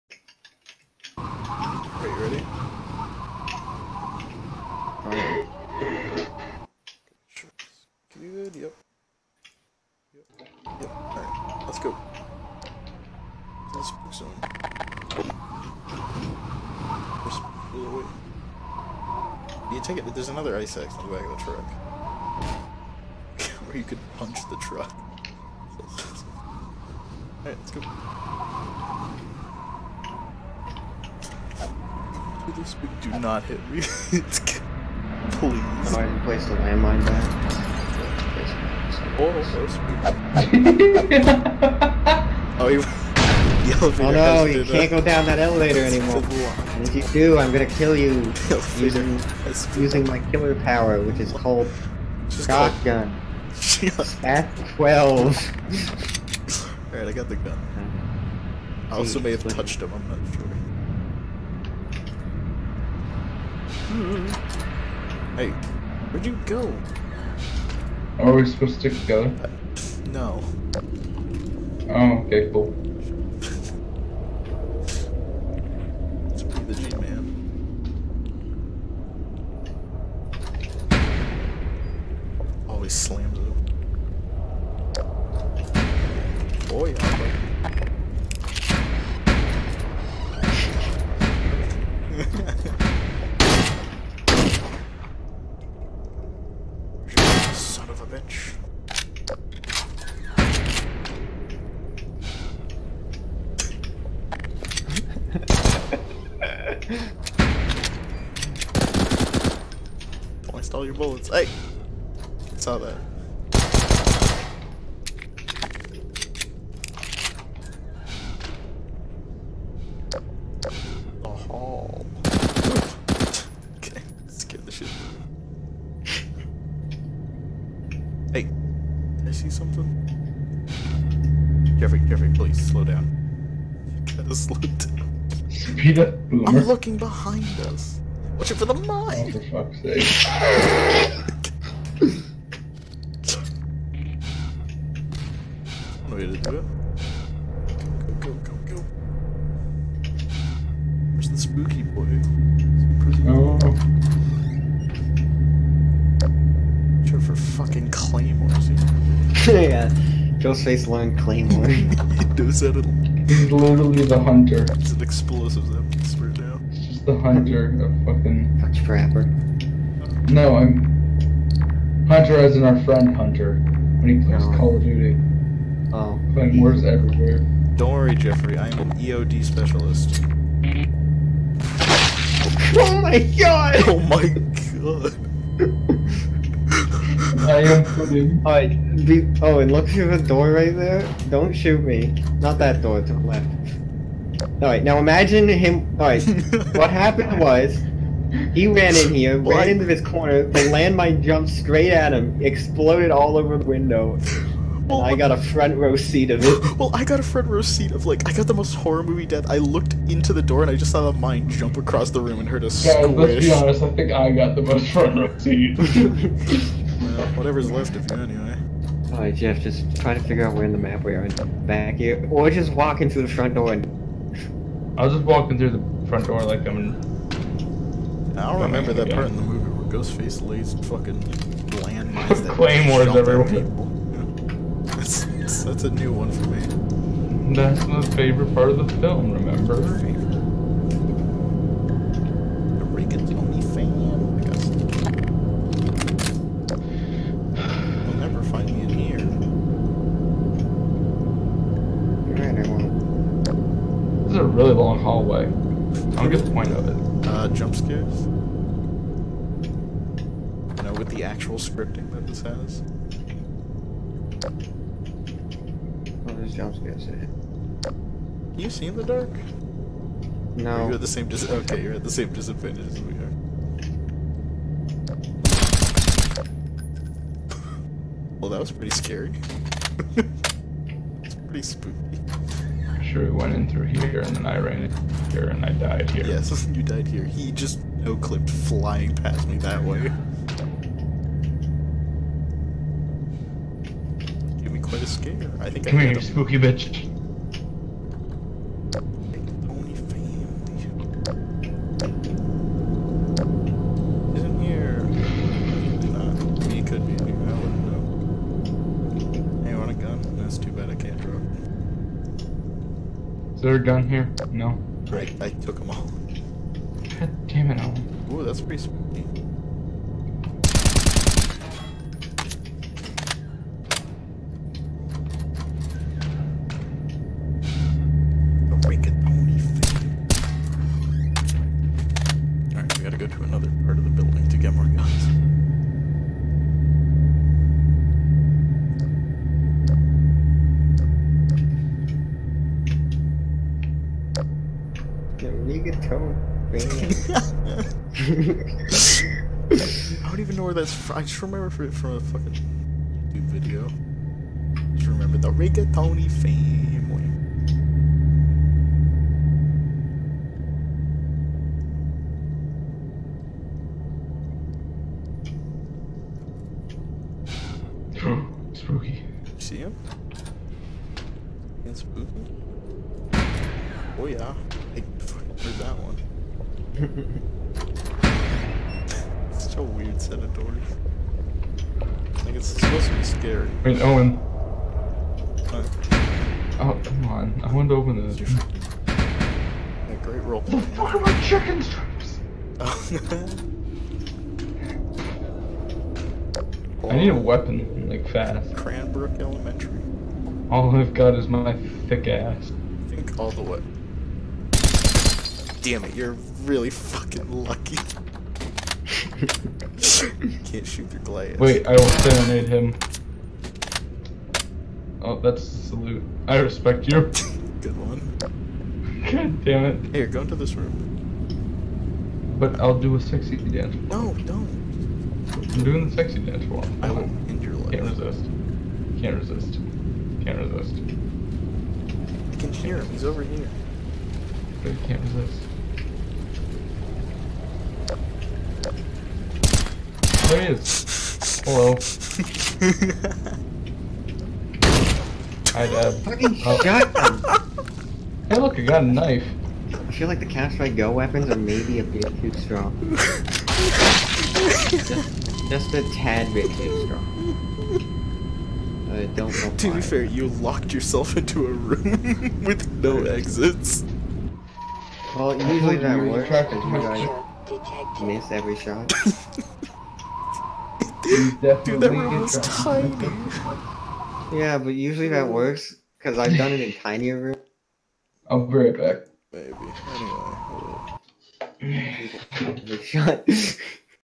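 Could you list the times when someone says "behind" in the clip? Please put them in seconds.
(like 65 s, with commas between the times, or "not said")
136 s.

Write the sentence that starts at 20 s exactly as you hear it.
There's another ice axe in the back of the truck.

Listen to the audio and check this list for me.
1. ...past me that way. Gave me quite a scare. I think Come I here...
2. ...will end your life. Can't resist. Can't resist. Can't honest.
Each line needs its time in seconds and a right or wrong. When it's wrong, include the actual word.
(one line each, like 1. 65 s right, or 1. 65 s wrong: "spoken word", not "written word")
1. 289 s right
2. 427 s wrong: "resist", not "honest".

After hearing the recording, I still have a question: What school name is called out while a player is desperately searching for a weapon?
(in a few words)
Cranbrook Elementary.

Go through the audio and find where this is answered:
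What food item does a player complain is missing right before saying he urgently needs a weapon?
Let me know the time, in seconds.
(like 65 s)
391 s.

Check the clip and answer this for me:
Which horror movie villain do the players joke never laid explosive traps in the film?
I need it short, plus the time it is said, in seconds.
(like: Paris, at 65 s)
Ghostface, at 230 s.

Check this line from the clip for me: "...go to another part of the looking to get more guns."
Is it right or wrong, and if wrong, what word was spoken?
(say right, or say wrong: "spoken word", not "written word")
wrong: "building", not "looking".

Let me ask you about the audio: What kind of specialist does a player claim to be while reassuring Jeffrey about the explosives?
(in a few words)
EOD specialist.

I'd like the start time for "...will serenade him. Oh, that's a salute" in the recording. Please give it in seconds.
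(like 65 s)
411 s.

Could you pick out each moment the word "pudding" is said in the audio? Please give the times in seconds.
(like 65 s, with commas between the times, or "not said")
187 s.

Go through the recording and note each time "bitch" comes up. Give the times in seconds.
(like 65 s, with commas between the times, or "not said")
98 s, 296 s.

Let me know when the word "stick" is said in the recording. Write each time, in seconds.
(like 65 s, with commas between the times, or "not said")
68 s.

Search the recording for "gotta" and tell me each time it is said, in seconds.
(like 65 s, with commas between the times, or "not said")
134 s, 333 s.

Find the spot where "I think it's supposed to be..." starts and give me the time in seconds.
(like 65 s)
382 s.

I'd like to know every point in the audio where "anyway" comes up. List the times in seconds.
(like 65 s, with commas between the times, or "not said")
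218 s, 481 s.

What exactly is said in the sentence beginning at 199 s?
ran into this corner, the landmine jumped straight at him, exploded all over the window.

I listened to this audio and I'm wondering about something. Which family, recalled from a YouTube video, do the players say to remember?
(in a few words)
Rigatoni family.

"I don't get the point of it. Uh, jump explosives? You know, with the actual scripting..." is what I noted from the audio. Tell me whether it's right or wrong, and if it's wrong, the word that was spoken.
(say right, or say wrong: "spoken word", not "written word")
wrong: "scares", not "explosives".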